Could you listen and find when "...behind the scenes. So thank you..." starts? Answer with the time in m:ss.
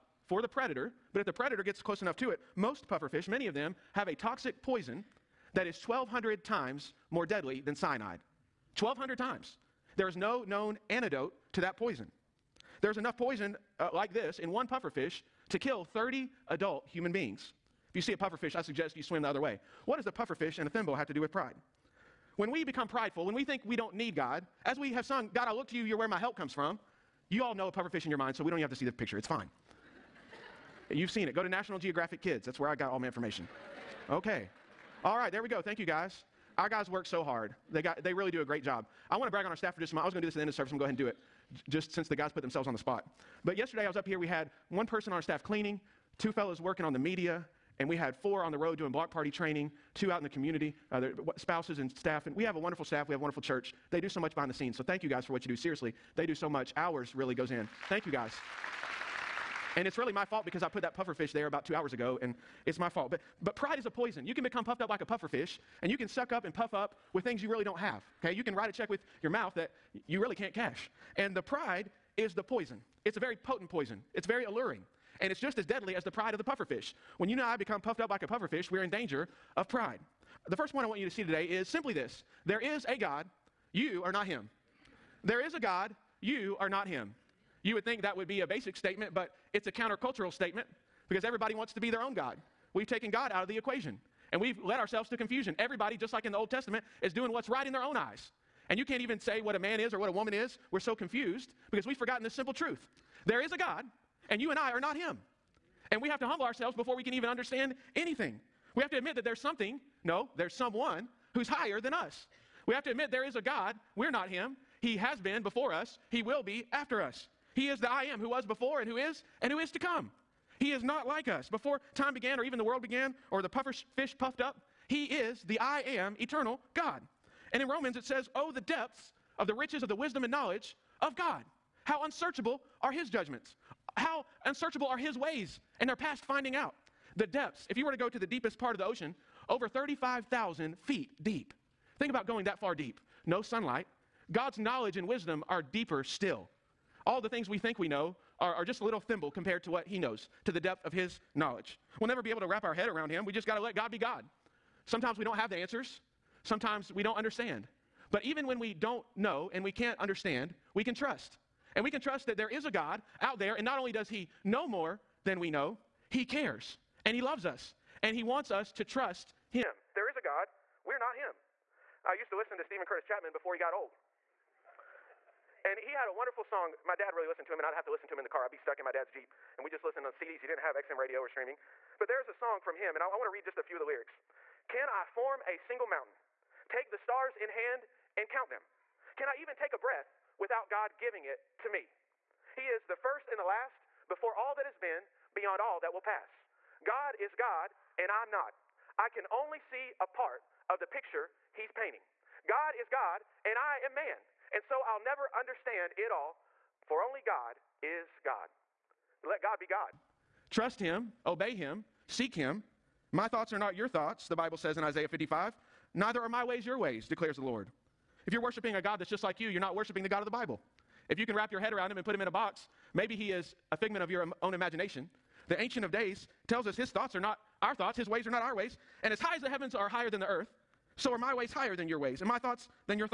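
0:54.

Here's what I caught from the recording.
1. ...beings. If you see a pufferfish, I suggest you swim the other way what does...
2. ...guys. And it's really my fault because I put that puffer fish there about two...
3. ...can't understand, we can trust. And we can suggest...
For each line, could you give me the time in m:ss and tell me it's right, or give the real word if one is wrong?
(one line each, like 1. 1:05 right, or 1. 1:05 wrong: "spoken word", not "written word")
1. 0:17 right
2. 0:58 right
3. 2:39 wrong: "trust", not "suggest".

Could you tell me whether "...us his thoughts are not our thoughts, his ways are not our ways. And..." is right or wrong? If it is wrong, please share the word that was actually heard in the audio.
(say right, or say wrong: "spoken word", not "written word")
right.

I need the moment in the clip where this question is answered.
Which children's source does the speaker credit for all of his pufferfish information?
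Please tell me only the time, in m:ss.
0:31.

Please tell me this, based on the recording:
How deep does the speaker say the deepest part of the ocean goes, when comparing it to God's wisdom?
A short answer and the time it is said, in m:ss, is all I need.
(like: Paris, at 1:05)
Over 35,000 feet, at 2:19.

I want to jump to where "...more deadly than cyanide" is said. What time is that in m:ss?
0:07.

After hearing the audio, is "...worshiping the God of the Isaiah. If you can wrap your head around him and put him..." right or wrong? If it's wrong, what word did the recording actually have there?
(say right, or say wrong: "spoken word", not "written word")
wrong: "Bible", not "Isaiah".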